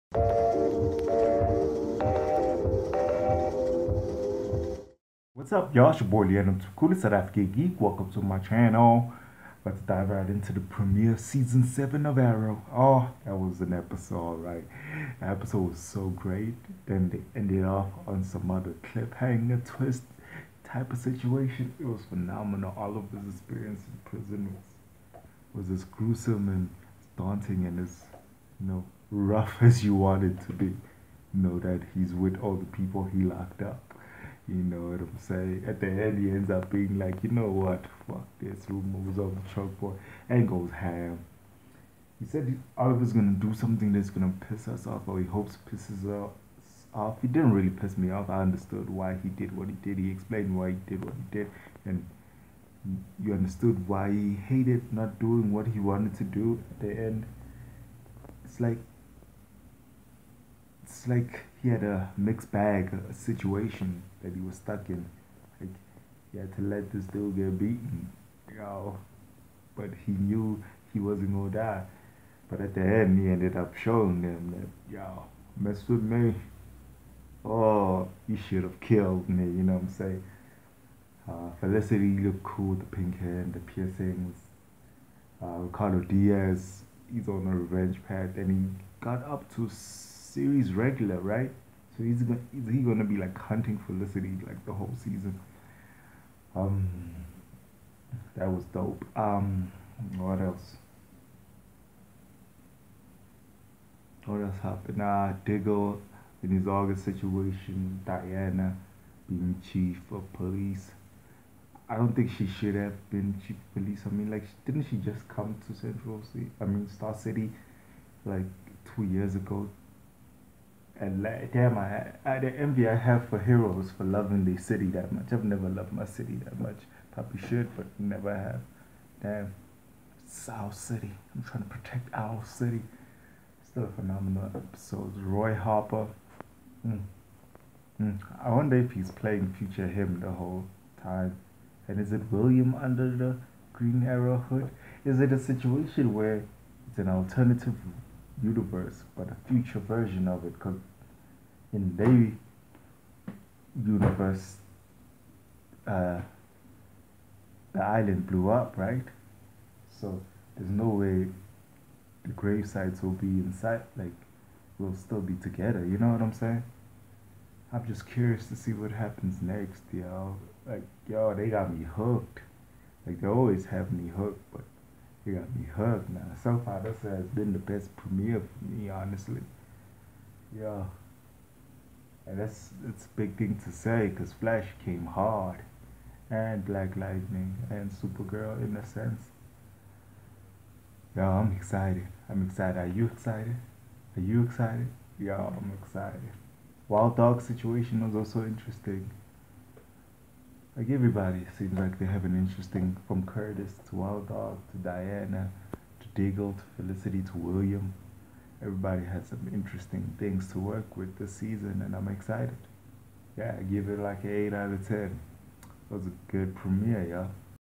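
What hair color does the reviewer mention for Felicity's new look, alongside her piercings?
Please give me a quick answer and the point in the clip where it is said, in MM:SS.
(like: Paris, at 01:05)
Pink, at 01:22.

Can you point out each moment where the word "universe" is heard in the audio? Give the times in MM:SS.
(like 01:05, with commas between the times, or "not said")
02:28, 02:33.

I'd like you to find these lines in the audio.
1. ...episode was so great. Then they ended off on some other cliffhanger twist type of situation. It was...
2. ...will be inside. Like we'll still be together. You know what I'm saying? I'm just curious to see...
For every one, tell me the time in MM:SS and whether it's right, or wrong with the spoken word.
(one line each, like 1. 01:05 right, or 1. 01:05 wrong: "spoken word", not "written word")
1. 00:15 right
2. 02:43 right.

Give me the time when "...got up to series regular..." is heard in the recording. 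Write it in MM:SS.
01:29.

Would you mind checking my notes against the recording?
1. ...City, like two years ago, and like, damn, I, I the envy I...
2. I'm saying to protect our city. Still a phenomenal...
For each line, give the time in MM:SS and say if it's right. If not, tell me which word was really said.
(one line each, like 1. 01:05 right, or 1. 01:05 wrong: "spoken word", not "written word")
1. 01:57 right
2. 02:11 wrong: "trying", not "saying".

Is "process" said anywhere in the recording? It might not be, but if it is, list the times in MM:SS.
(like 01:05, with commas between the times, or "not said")
not said.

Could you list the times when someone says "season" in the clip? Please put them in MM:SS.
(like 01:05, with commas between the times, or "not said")
00:11, 01:34, 03:31.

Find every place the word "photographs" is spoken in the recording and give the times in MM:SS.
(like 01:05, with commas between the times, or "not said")
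not said.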